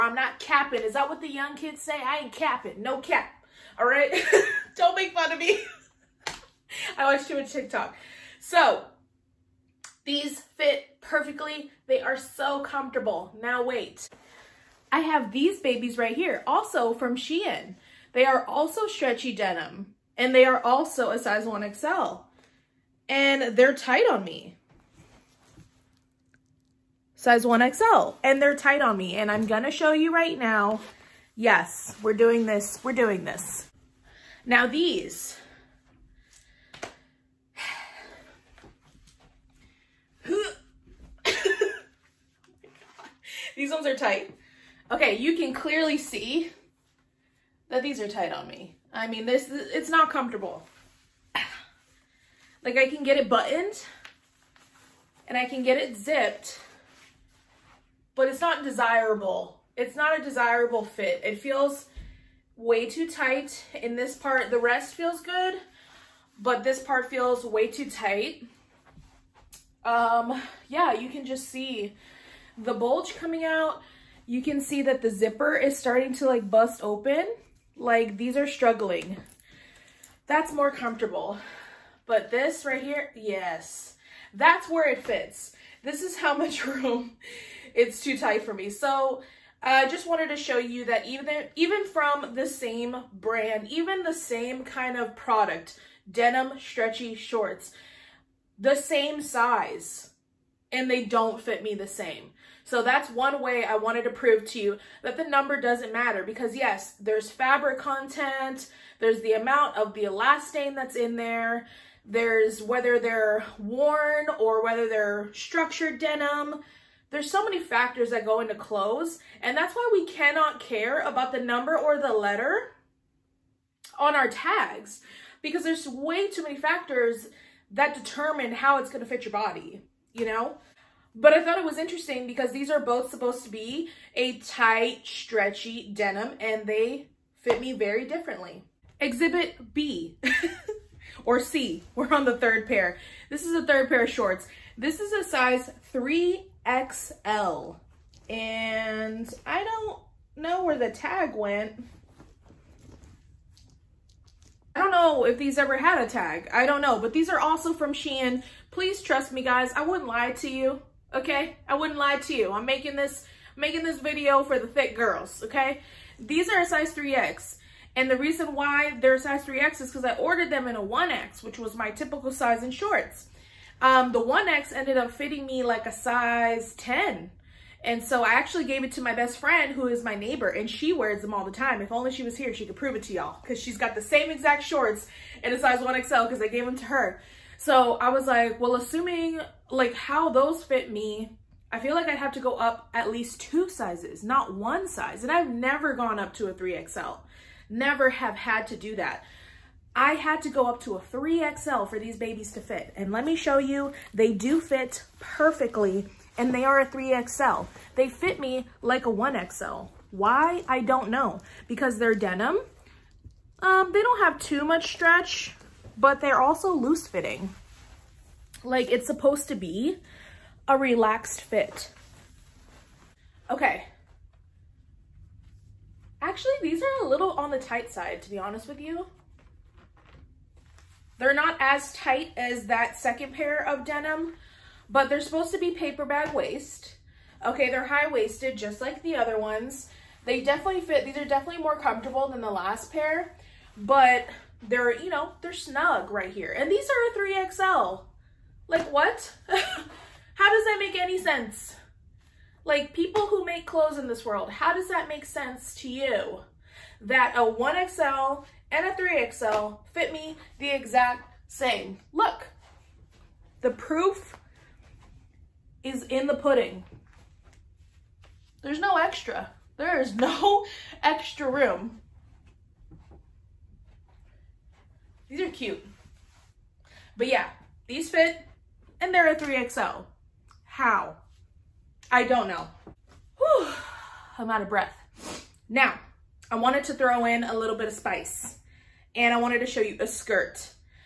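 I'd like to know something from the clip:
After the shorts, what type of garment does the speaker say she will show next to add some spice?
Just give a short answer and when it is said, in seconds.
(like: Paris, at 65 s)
A skirt, at 289 s.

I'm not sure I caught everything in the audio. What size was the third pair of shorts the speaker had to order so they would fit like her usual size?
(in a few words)
3XL.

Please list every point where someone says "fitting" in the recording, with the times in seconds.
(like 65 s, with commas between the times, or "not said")
175 s, 217 s.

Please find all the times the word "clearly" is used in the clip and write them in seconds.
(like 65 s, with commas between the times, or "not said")
45 s.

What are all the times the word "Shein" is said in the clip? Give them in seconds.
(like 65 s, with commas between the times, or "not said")
17 s, 157 s.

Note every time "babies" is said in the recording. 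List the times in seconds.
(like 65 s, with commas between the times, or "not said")
15 s, 202 s.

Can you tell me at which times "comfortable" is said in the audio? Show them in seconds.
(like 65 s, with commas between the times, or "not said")
12 s, 50 s, 80 s, 241 s.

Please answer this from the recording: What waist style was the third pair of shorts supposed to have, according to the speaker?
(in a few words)
Paper bag waist.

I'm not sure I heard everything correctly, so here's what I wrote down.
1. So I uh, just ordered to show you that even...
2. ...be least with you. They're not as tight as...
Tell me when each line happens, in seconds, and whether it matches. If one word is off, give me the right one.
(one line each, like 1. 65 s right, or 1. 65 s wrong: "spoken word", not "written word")
1. 88 s wrong: "wanted", not "ordered"
2. 228 s wrong: "honest", not "least".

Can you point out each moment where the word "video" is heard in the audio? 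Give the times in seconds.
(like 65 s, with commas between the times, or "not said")
163 s.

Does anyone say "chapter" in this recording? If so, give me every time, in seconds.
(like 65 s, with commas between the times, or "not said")
not said.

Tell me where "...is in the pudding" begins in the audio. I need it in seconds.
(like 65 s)
265 s.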